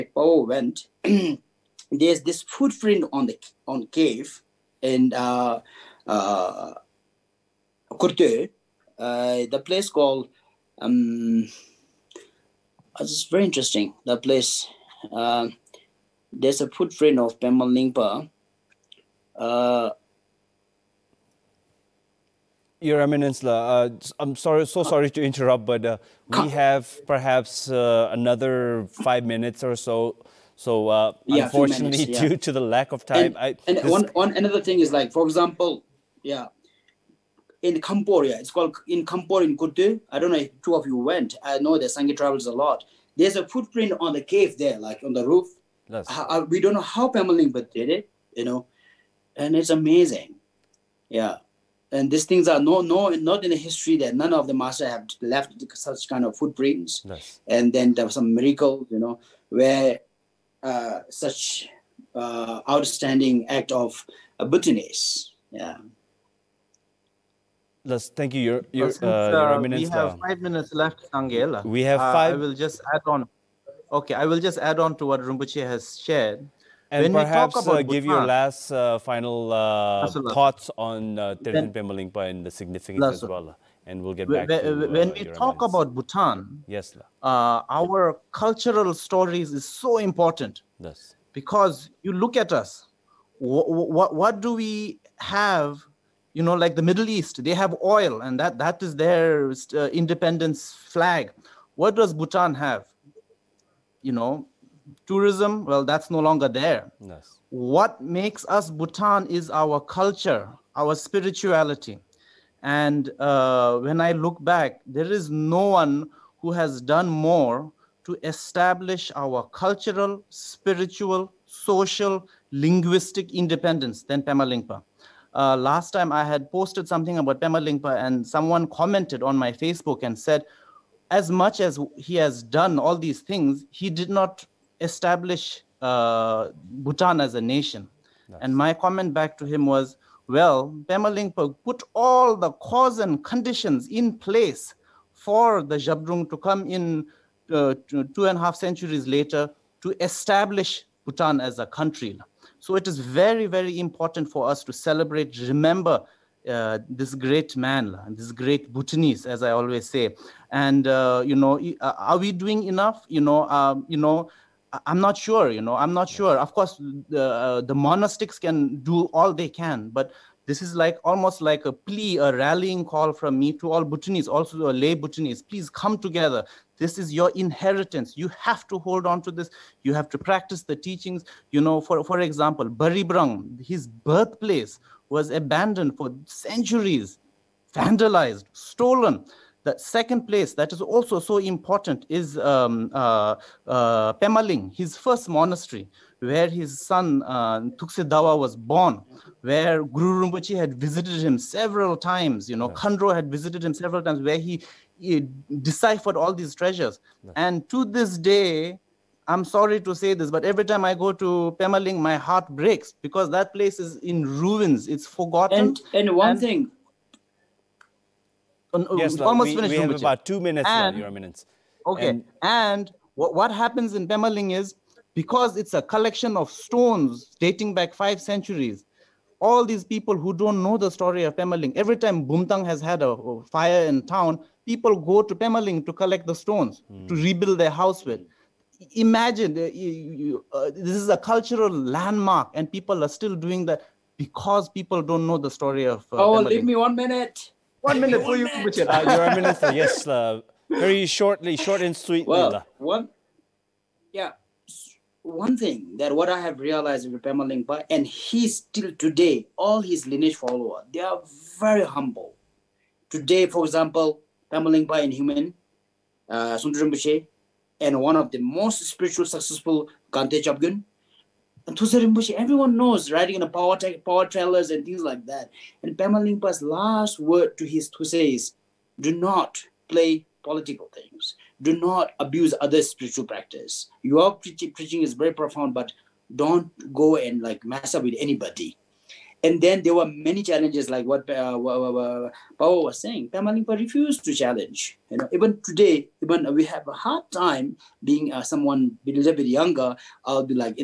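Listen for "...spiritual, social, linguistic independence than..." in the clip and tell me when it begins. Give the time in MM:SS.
02:00.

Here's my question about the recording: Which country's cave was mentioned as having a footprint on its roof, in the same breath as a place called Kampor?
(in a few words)
Cambodia.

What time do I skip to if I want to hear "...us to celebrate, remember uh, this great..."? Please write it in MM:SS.
02:34.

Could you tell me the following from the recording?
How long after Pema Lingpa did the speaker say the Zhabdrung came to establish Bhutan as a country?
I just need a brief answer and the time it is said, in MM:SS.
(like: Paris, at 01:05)
Two and a half centuries, at 02:27.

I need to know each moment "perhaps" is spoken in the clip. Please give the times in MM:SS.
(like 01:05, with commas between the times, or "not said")
00:27, 01:17.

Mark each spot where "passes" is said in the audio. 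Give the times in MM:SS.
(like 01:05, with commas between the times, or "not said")
not said.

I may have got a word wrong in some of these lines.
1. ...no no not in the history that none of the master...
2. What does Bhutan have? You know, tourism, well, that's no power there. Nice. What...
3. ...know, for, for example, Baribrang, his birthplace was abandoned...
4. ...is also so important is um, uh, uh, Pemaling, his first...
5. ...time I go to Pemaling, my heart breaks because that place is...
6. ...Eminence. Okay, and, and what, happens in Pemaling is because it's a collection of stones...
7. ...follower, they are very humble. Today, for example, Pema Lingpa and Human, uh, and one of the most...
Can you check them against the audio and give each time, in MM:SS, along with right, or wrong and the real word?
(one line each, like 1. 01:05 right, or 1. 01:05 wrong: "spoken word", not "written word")
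1. 00:52 right
2. 01:41 wrong: "longer", not "power"
3. 03:01 right
4. 03:10 right
5. 03:30 right
6. 03:41 right
7. 04:20 right.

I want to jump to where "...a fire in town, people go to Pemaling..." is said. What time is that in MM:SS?
03:53.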